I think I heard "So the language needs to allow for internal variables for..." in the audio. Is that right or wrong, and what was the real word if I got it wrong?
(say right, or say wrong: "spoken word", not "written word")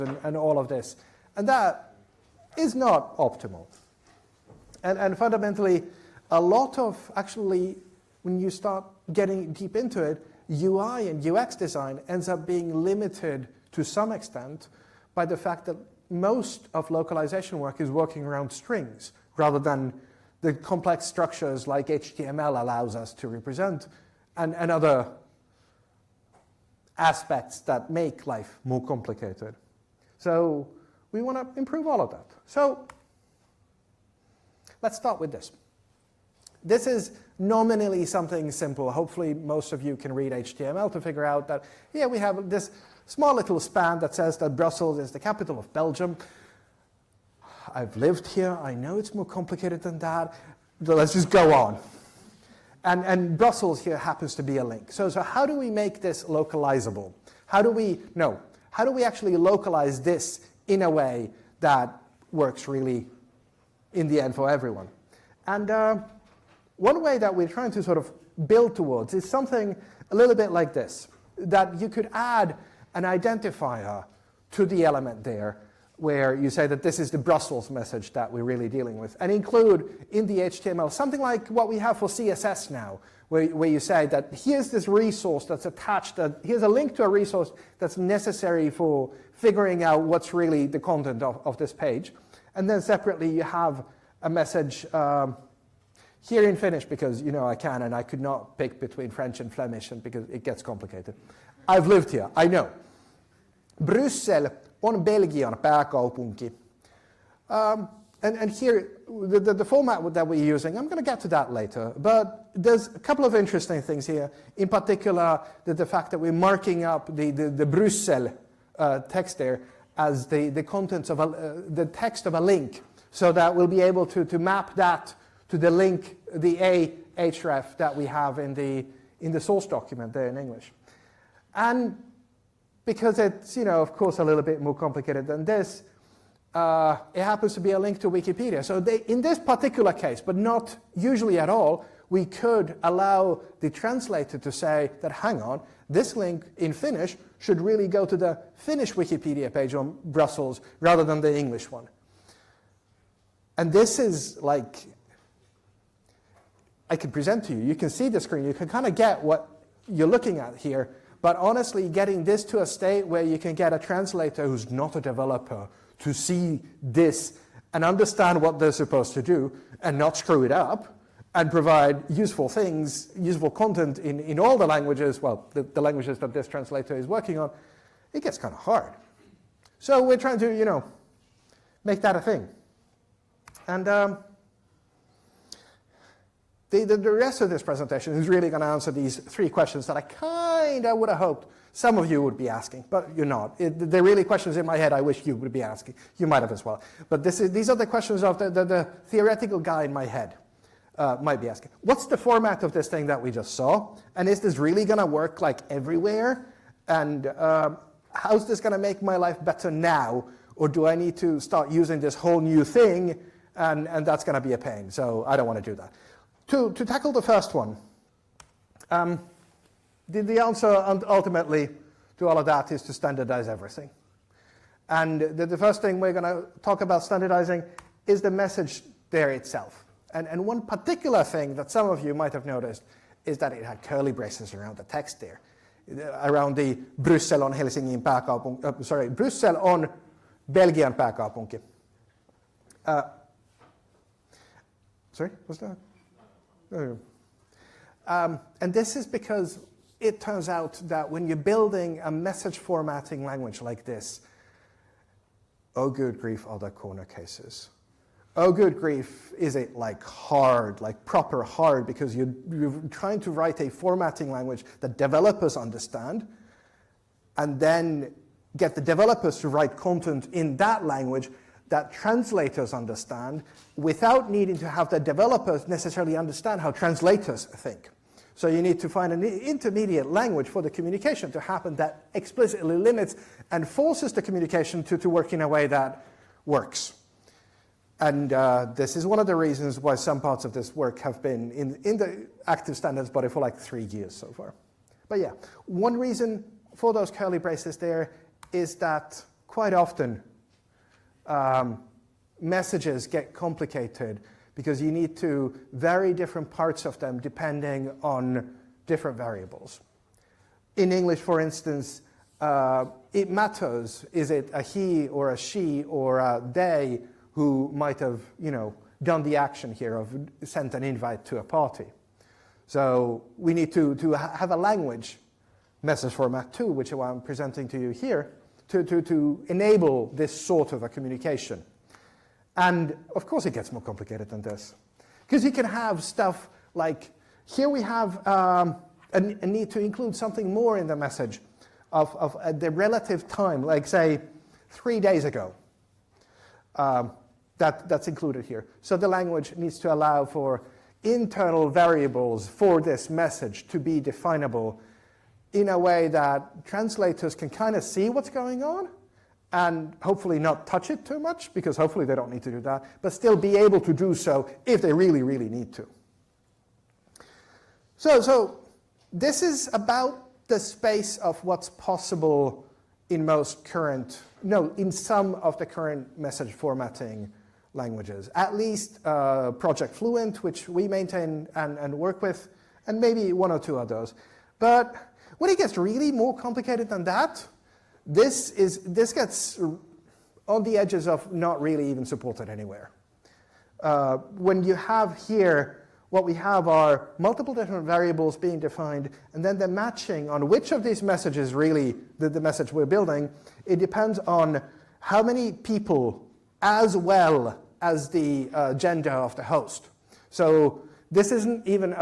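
right.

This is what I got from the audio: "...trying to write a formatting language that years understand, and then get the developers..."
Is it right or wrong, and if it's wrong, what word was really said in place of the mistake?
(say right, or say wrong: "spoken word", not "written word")
wrong: "developers", not "years".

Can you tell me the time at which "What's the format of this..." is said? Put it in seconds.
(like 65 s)
201 s.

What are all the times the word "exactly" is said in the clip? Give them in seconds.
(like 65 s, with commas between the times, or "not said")
not said.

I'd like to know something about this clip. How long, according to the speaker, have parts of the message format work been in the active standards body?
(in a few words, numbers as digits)
3 years.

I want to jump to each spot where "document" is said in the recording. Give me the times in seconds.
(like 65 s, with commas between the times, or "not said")
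129 s.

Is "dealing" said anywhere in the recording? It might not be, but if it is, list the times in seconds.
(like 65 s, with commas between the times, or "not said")
78 s.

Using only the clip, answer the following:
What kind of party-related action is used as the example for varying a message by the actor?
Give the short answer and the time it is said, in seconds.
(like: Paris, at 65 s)
sent an invite, at 320 s.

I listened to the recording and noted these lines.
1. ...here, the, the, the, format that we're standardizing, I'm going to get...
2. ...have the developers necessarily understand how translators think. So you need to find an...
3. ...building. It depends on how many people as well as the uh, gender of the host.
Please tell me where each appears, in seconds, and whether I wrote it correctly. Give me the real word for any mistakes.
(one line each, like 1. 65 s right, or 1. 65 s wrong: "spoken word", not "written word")
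1. 108 s wrong: "using", not "standardizing"
2. 274 s right
3. 402 s right.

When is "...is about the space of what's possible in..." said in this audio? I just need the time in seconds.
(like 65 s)
369 s.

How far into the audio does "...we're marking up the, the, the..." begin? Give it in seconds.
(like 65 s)
116 s.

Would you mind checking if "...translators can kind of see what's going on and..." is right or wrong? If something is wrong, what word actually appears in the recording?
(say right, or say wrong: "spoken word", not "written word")
right.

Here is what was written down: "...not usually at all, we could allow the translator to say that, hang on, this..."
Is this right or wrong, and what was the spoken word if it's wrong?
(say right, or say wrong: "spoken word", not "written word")
right.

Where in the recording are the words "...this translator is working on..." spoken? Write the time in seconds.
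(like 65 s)
176 s.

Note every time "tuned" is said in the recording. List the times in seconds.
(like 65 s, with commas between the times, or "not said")
not said.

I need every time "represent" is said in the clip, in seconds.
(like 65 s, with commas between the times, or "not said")
23 s.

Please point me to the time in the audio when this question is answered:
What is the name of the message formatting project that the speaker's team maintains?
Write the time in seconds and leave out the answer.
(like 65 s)
379 s.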